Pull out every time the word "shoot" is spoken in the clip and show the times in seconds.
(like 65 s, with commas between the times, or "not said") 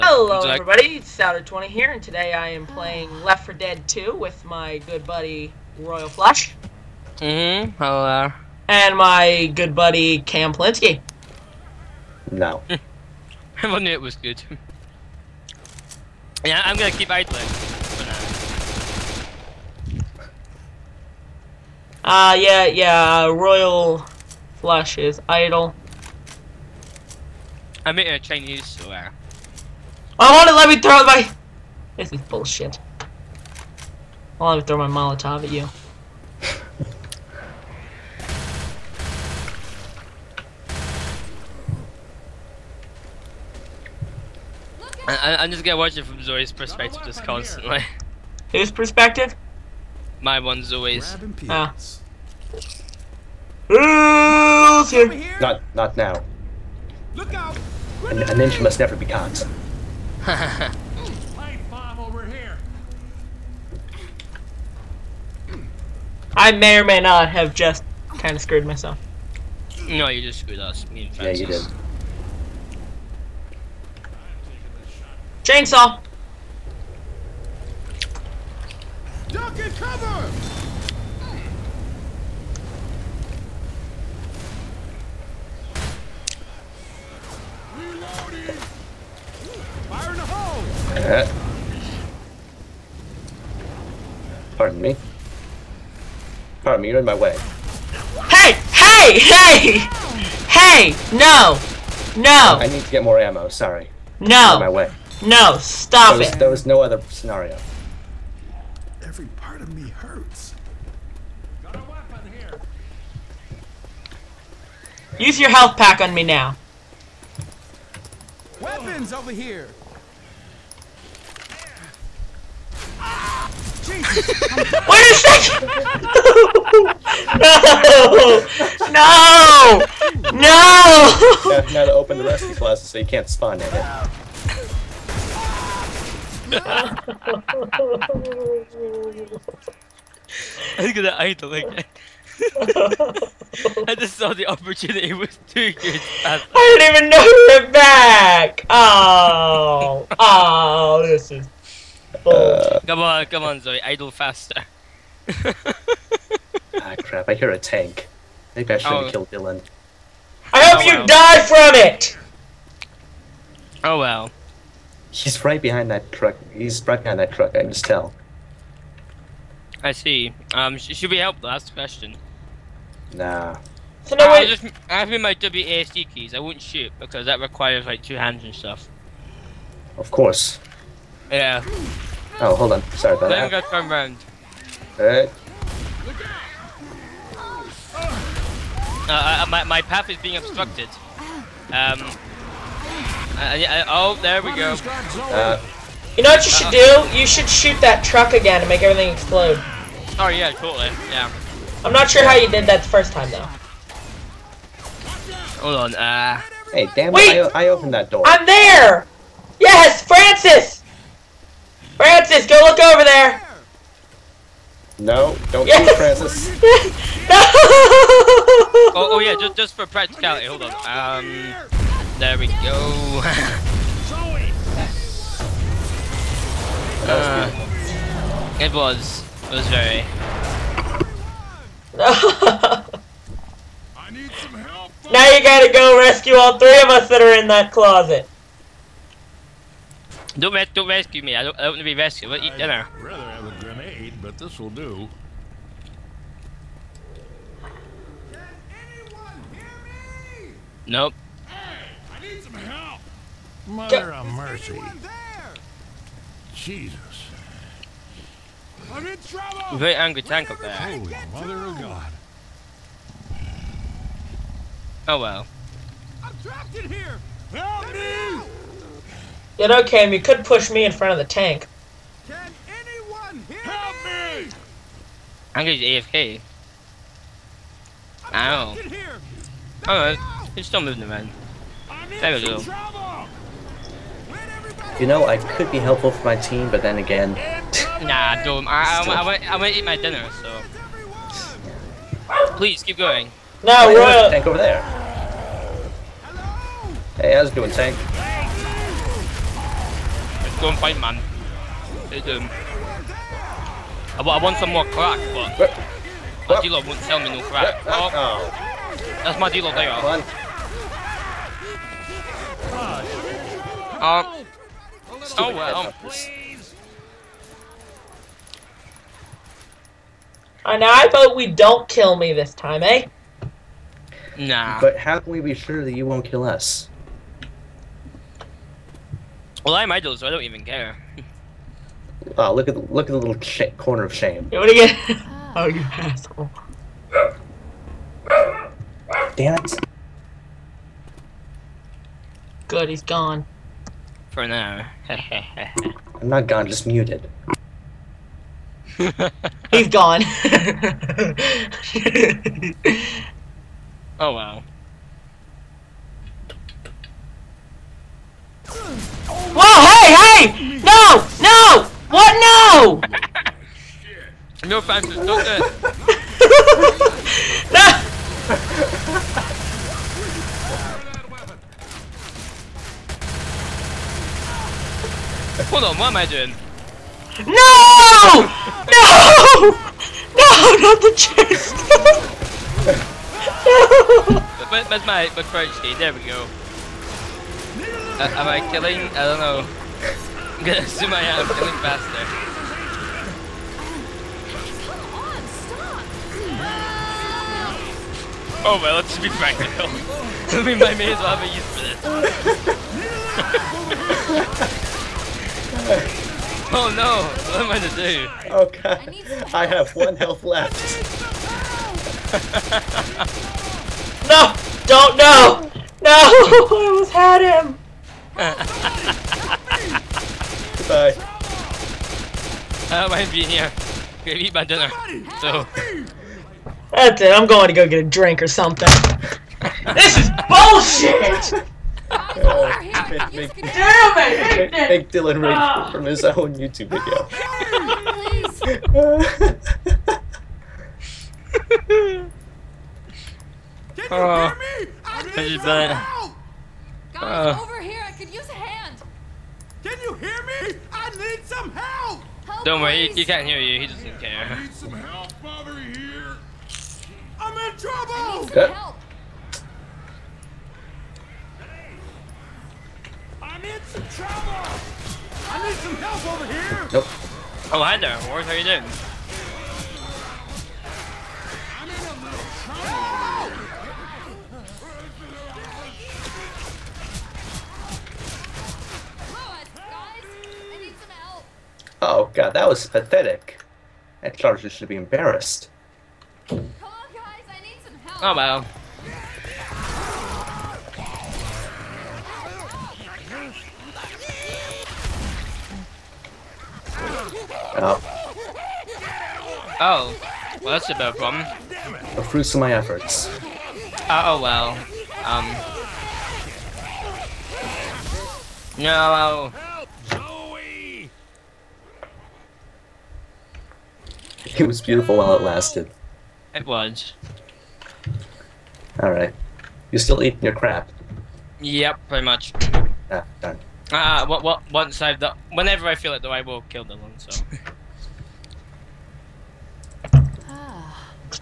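176 s, 197 s, 215 s.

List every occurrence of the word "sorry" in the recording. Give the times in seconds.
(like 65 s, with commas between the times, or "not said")
103 s, 182 s.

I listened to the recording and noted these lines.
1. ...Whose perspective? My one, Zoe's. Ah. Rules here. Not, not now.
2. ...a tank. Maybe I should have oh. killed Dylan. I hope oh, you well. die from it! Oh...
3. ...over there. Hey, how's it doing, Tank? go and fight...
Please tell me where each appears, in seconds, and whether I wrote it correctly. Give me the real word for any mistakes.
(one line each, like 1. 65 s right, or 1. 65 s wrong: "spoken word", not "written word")
1. 48 s right
2. 157 s right
3. 294 s right.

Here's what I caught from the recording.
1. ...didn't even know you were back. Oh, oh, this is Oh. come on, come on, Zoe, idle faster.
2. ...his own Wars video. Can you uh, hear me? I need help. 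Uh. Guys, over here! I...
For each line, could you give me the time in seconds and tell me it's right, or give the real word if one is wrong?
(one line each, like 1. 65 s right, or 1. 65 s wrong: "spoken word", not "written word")
1. 146 s right
2. 436 s wrong: "YouTube", not "Wars".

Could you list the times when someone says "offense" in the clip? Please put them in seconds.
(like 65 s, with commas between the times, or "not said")
364 s.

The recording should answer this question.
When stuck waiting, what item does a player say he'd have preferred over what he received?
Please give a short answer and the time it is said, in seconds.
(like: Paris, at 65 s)
A grenade, at 243 s.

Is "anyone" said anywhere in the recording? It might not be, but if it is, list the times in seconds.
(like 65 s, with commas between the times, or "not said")
248 s, 272 s.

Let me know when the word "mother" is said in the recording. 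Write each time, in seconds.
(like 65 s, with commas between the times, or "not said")
253 s, 261 s.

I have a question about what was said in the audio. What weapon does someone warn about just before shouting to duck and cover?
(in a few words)
Chainsaw.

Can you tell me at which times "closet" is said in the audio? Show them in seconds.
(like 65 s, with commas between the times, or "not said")
132 s, 237 s.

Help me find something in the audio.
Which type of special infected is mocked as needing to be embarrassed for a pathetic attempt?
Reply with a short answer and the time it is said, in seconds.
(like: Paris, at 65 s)
Charger, at 484 s.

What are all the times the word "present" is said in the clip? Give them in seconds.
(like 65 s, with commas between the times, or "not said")
not said.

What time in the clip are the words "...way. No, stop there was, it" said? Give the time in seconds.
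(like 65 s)
104 s.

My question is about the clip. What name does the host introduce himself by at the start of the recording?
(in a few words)
Souder 20.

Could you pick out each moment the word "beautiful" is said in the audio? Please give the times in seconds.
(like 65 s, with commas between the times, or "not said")
514 s.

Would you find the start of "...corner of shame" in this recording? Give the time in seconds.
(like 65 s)
333 s.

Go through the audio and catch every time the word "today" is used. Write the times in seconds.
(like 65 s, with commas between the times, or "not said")
2 s.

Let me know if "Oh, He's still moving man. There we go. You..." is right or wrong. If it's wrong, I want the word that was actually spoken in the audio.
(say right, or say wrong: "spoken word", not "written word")
right.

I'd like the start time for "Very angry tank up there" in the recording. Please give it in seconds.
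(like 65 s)
259 s.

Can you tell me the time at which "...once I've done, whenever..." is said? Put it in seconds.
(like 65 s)
524 s.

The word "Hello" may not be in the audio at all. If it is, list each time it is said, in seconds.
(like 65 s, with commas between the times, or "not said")
0 s, 7 s.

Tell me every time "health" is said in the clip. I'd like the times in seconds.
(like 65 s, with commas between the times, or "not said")
115 s, 410 s.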